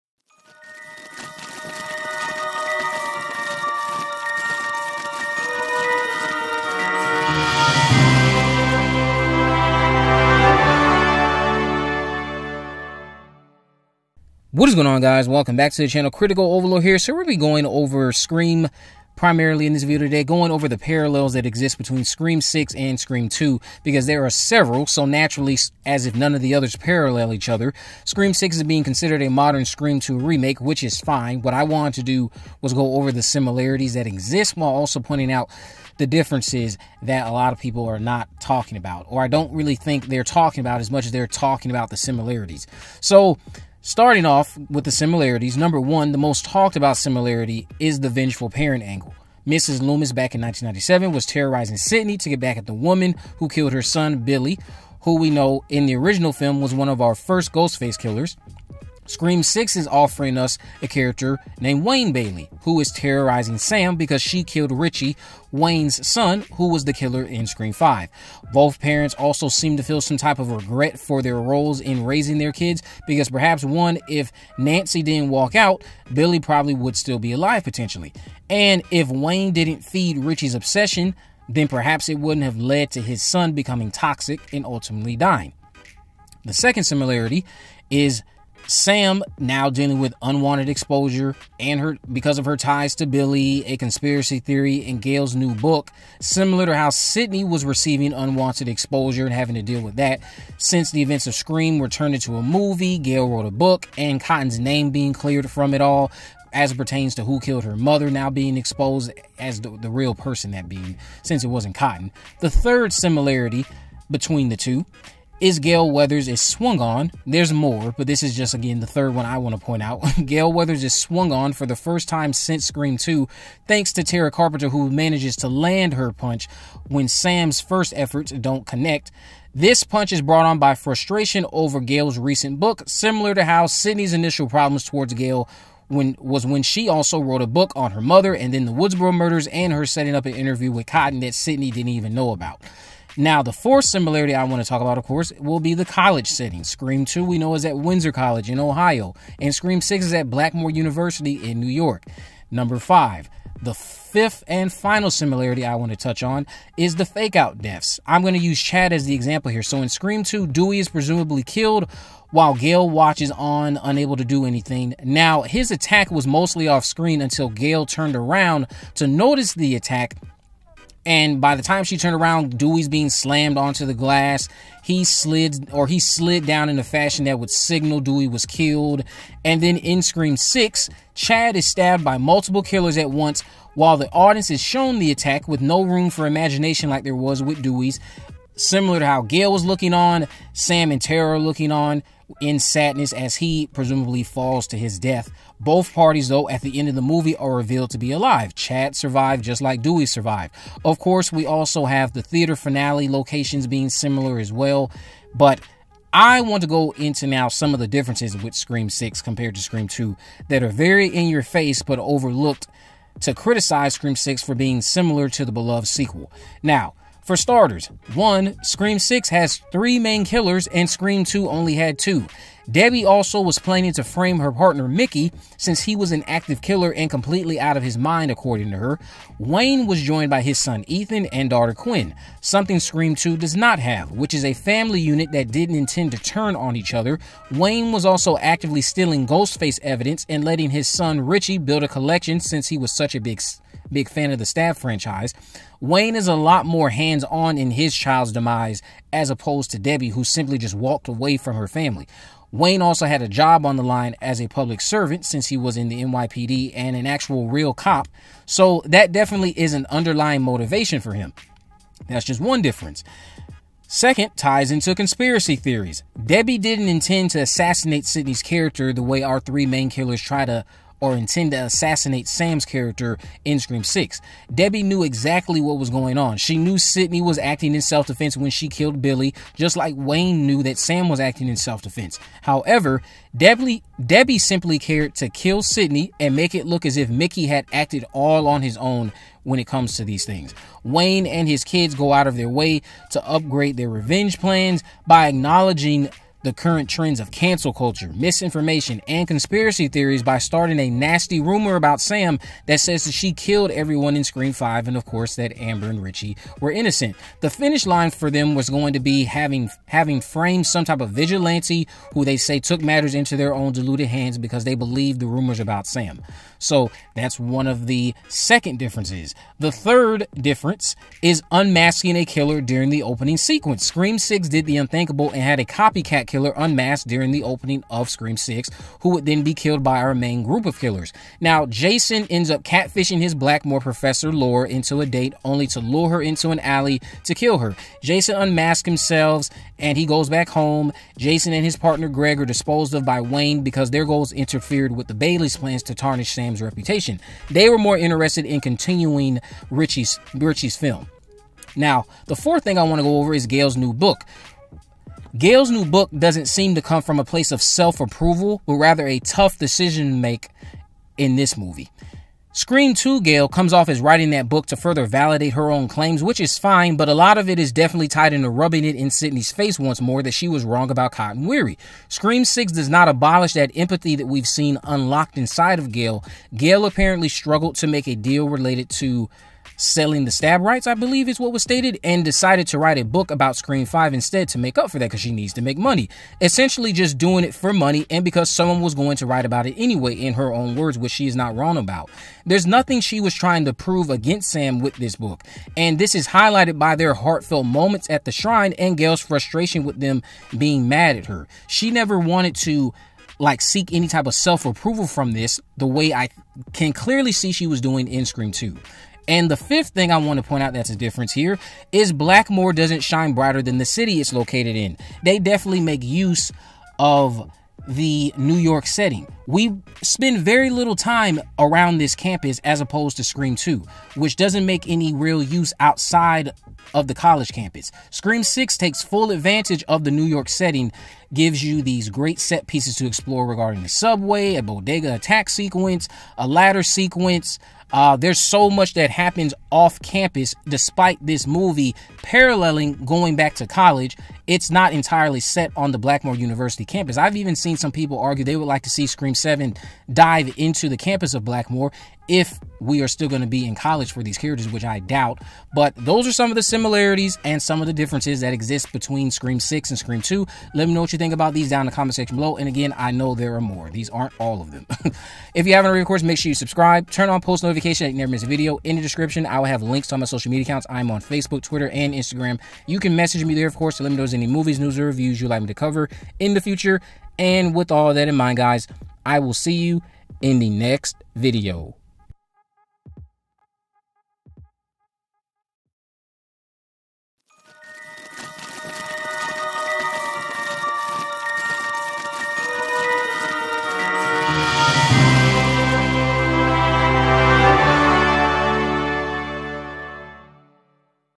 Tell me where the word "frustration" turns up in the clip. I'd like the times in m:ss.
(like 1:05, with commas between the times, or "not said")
2:10, 6:39.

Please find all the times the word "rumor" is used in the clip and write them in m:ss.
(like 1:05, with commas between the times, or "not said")
5:01, 5:15.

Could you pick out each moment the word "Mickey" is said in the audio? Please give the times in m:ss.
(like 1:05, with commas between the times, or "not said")
3:44, 4:47.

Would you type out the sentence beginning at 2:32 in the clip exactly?
Number five, the fifth and final similarity I want to touch on is the fake out deaths.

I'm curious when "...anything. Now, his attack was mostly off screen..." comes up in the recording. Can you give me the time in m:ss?
2:44.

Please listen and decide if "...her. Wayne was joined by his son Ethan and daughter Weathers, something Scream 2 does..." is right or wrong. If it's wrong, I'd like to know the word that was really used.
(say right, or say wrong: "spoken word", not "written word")
wrong: "Quinn", not "Weathers".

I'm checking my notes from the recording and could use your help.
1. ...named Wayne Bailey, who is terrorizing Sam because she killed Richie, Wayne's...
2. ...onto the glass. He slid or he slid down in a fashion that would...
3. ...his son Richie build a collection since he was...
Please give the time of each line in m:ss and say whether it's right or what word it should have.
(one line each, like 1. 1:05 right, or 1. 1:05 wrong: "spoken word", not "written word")
1. 1:01 right
2. 2:53 right
3. 4:00 right.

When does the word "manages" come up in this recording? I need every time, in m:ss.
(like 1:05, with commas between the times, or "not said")
2:04.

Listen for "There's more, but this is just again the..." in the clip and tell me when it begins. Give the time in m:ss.
1:57.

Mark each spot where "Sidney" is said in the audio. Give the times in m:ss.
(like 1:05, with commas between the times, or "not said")
0:51, 1:36, 2:13, 2:21, 4:28, 4:36, 4:45, 6:09.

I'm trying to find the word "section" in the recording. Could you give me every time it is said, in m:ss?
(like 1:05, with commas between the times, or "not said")
7:42.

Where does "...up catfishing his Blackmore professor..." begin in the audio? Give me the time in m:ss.
5:32.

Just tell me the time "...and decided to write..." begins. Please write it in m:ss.
6:22.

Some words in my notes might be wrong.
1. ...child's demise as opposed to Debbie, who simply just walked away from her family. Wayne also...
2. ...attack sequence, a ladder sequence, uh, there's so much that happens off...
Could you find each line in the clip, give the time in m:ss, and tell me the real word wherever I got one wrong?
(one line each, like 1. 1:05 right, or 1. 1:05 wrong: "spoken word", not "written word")
1. 4:07 right
2. 7:15 right.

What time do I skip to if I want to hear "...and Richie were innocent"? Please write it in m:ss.
5:05.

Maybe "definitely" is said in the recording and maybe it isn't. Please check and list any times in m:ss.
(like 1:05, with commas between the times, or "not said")
4:19, 6:07, 6:55.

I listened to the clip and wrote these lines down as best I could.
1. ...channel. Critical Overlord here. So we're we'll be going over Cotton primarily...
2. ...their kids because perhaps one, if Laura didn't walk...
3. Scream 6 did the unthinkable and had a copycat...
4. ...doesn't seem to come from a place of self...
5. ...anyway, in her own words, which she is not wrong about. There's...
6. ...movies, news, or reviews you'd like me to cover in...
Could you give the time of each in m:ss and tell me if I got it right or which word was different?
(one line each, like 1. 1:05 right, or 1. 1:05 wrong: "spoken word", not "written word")
1. 0:15 wrong: "Scream", not "Cotton"
2. 1:12 wrong: "Nancy", not "Laura"
3. 5:23 right
4. 5:56 right
5. 6:29 right
6. 7:54 right.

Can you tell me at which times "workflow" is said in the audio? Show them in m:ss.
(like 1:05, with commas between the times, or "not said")
not said.